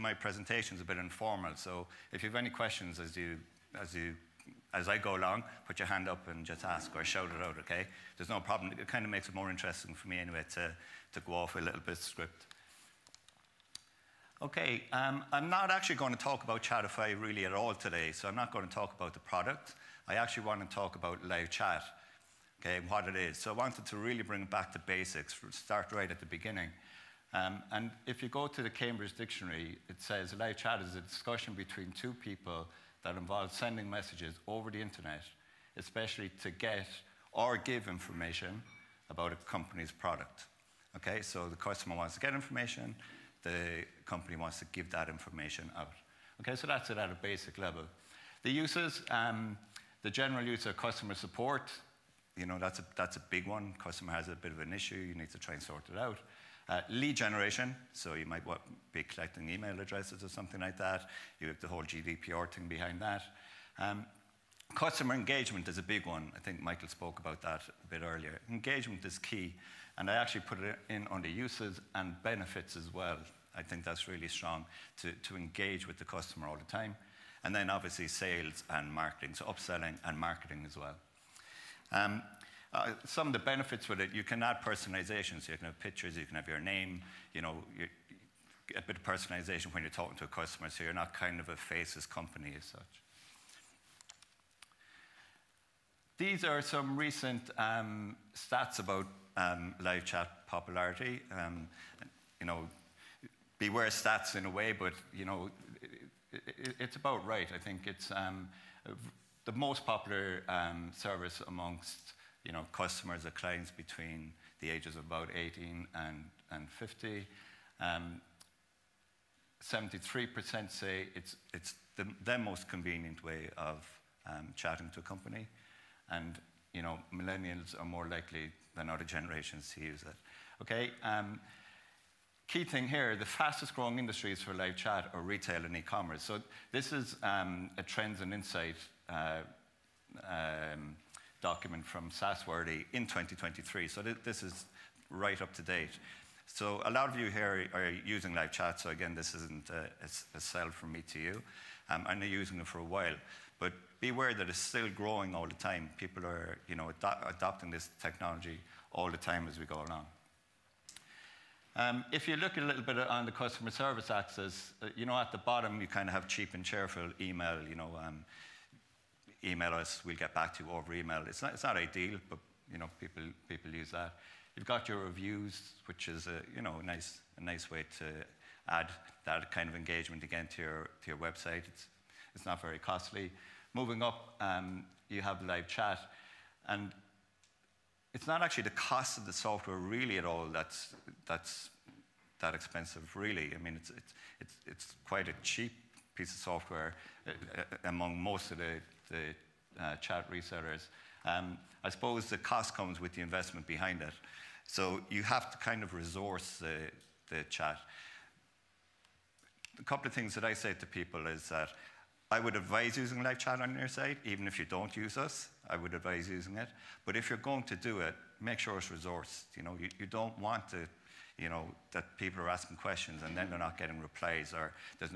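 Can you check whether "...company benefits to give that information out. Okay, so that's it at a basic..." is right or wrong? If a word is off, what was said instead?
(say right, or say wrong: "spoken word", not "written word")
wrong: "wants", not "benefits".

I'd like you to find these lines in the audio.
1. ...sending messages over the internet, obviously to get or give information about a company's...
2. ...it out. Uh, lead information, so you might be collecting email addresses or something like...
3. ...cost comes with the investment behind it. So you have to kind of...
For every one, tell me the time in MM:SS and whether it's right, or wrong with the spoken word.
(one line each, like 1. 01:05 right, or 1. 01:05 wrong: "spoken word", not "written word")
1. 00:33 wrong: "especially", not "obviously"
2. 00:55 wrong: "generation", not "information"
3. 03:22 right.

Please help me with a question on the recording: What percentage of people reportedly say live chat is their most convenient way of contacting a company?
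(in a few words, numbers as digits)
73%.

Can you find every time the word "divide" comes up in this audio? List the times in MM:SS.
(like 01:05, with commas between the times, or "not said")
not said.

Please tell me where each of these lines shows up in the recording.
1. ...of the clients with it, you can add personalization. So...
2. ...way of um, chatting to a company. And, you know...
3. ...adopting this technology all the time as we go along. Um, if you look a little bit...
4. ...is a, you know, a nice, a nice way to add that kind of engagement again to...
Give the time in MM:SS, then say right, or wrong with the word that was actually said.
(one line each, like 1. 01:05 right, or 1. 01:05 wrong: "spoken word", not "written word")
1. 01:23 wrong: "benefits", not "clients"
2. 02:03 right
3. 02:37 right
4. 02:56 right.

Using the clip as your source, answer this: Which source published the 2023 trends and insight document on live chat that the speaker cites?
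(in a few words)
SaaSworthy.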